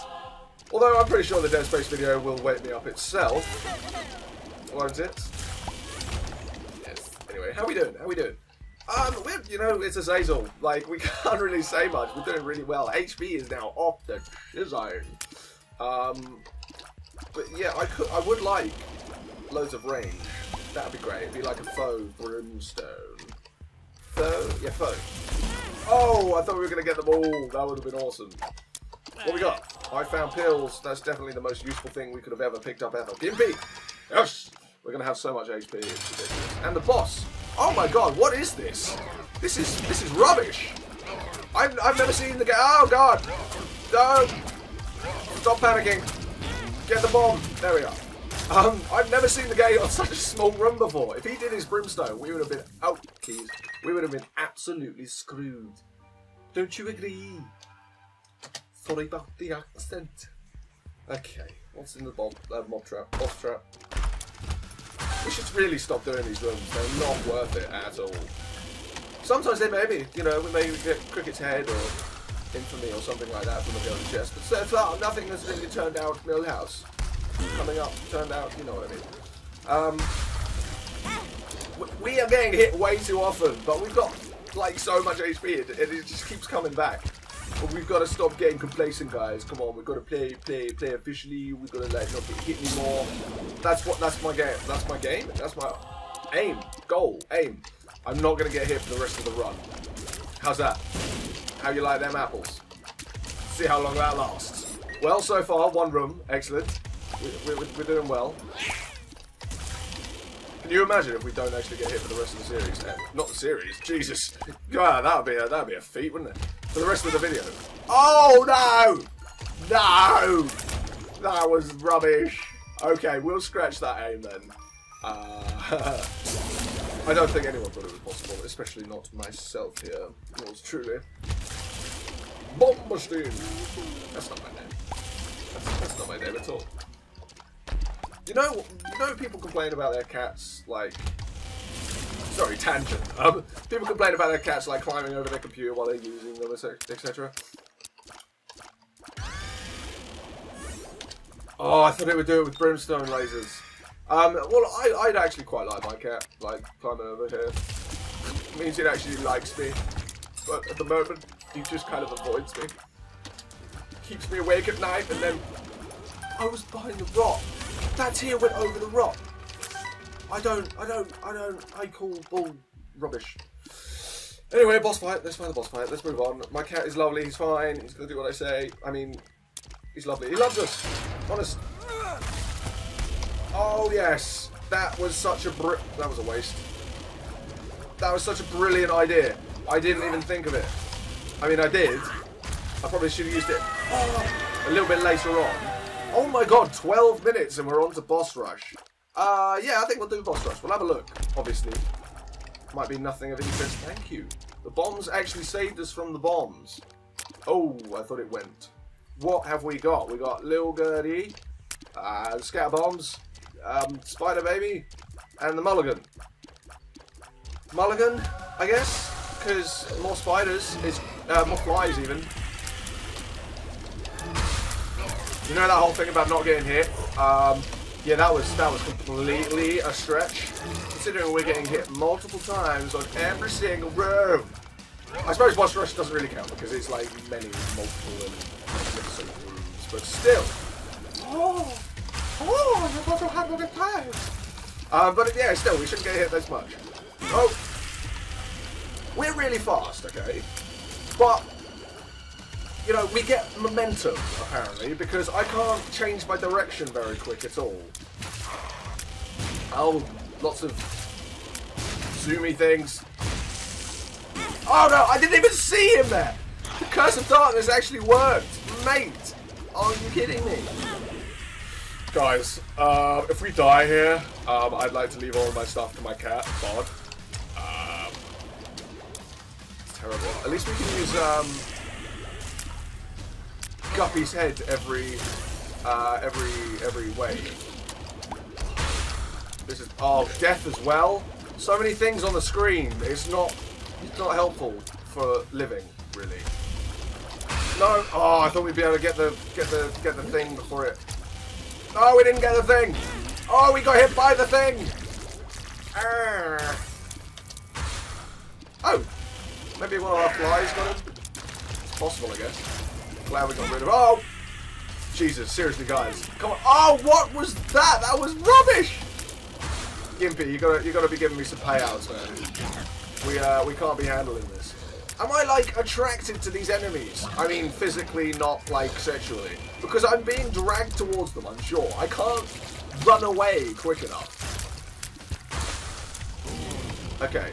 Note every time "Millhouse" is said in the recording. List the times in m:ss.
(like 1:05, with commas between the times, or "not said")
1:16.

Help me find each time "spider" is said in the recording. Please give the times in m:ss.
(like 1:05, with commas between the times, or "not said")
3:34, 3:40.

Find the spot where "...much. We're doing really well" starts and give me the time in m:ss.
0:11.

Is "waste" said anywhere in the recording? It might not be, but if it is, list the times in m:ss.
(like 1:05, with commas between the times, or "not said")
3:06.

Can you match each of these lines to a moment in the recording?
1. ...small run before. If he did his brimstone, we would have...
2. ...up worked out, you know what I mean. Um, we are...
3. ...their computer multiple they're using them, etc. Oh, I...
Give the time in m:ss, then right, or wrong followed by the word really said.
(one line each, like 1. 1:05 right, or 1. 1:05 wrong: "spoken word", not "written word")
1. 0:50 right
2. 1:17 wrong: "turned", not "worked"
3. 2:25 wrong: "while", not "multiple".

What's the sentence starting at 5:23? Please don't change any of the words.
We, uh, we can't be handling this.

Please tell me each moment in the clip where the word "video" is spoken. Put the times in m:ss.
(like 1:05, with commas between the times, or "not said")
0:01, 1:57.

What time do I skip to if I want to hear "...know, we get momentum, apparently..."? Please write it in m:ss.
4:12.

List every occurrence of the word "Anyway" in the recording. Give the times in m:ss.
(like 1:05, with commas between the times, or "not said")
0:07, 2:54.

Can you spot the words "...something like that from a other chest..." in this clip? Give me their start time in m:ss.
1:13.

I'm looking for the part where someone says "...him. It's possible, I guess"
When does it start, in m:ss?
5:10.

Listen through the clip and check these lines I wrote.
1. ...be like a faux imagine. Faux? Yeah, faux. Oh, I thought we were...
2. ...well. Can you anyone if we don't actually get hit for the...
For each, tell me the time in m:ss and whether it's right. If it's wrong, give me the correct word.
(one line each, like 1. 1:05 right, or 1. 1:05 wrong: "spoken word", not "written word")
1. 0:21 wrong: "brimstone", not "imagine"
2. 1:48 wrong: "imagine", not "anyone".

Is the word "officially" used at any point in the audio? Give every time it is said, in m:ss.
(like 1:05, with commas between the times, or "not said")
1:30.